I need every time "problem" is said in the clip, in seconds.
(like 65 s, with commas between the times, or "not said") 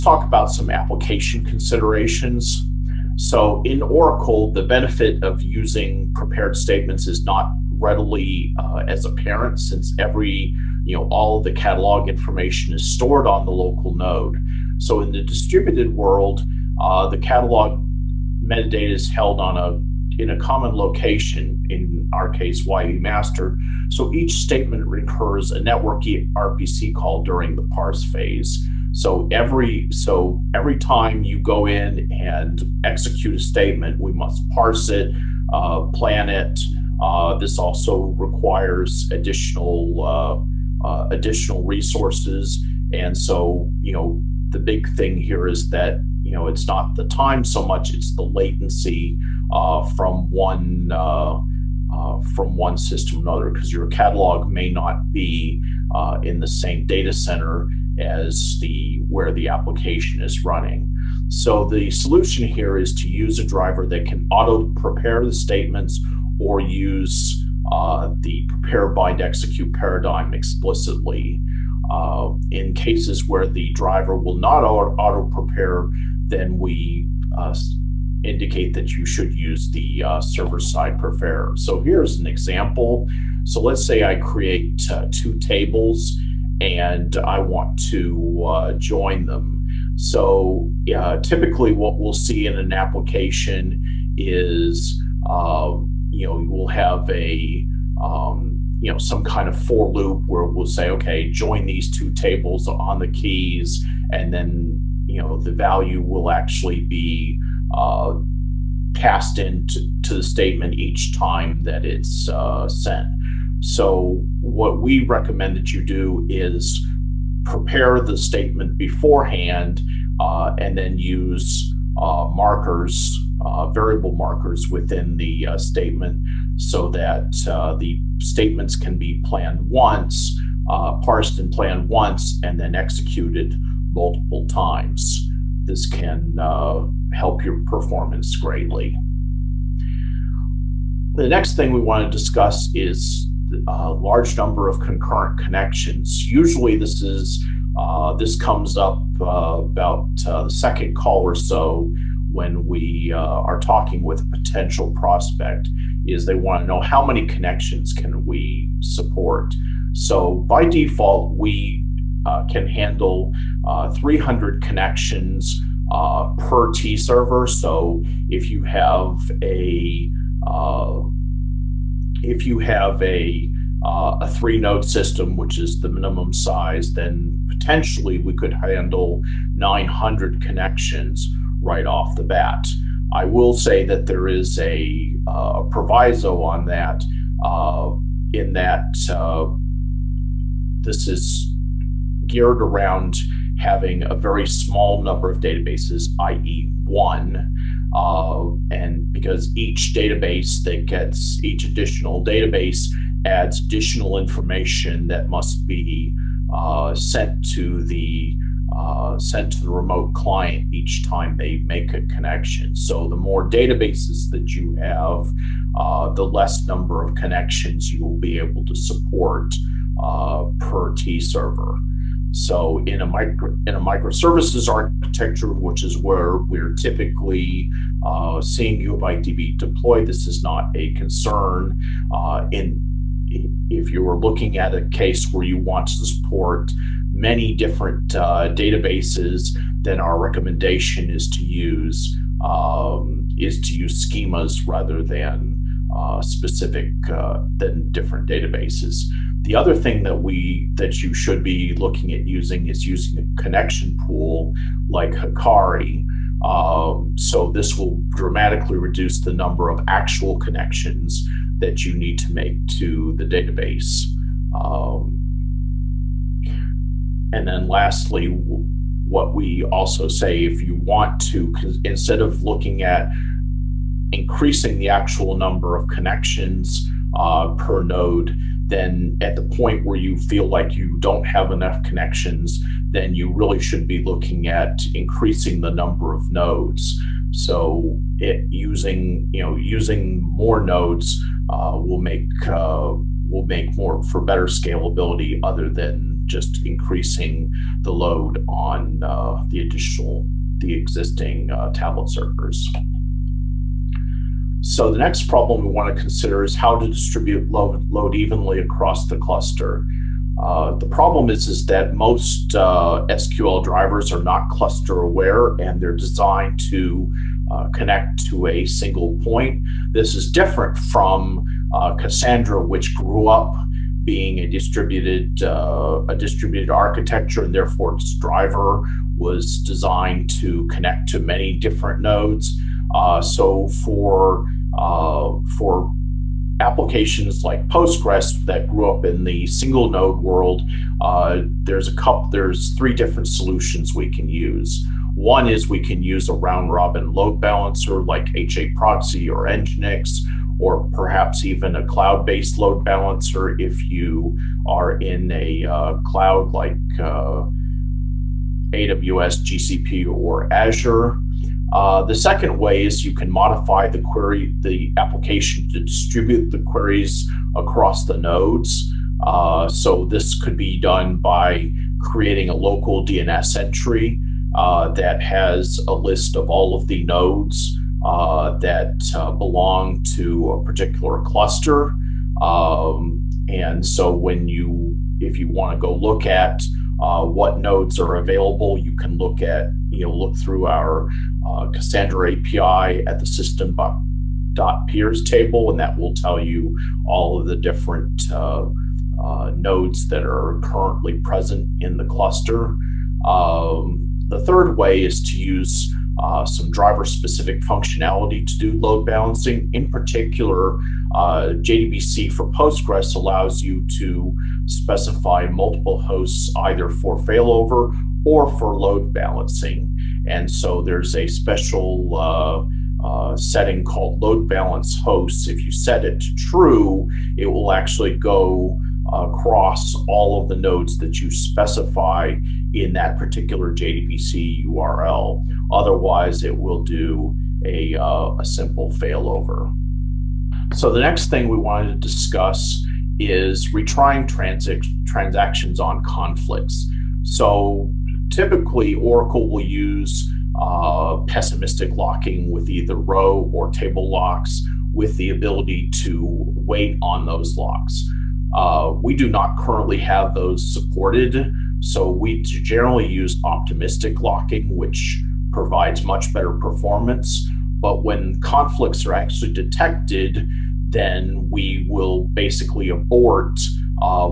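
305 s, 310 s.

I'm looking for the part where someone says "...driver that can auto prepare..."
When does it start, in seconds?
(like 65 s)
63 s.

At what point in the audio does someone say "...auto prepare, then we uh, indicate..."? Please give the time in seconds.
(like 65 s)
74 s.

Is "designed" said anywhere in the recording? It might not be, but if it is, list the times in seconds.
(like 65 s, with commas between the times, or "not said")
315 s, 329 s.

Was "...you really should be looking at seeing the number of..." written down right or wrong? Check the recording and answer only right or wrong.
wrong.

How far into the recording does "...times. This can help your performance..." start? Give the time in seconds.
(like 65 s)
134 s.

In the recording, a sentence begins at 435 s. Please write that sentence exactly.
Otherwise, it will do a, uh, a simple failover.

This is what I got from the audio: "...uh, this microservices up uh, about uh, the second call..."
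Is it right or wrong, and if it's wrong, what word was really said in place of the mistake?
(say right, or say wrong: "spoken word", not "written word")
wrong: "comes", not "microservices".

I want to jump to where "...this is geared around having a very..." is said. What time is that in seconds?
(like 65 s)
190 s.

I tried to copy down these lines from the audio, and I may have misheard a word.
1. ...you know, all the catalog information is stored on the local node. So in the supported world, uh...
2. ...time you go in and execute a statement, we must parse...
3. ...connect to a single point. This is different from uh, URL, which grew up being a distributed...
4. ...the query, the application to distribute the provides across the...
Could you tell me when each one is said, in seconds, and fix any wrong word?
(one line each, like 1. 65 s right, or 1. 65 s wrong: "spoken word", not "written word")
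1. 10 s wrong: "distributed", not "supported"
2. 30 s right
3. 317 s wrong: "Cassandra", not "URL"
4. 363 s wrong: "queries", not "provides".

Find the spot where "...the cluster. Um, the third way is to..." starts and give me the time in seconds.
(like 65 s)
401 s.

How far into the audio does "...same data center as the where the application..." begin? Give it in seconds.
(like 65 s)
56 s.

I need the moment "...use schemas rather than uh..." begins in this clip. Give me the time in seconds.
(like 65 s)
243 s.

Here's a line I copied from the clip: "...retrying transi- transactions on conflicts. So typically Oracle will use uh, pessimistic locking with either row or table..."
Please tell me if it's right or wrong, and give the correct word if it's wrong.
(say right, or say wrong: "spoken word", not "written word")
right.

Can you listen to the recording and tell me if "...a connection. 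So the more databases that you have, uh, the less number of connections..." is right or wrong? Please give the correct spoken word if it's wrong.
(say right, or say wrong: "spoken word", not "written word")
right.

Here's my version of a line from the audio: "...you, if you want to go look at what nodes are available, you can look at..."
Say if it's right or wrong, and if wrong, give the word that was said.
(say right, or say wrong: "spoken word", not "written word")
right.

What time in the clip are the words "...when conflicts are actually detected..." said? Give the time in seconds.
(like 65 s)
468 s.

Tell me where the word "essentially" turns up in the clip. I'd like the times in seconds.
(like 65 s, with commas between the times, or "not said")
not said.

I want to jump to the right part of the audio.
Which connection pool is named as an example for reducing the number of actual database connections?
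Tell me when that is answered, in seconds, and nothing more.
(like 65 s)
255 s.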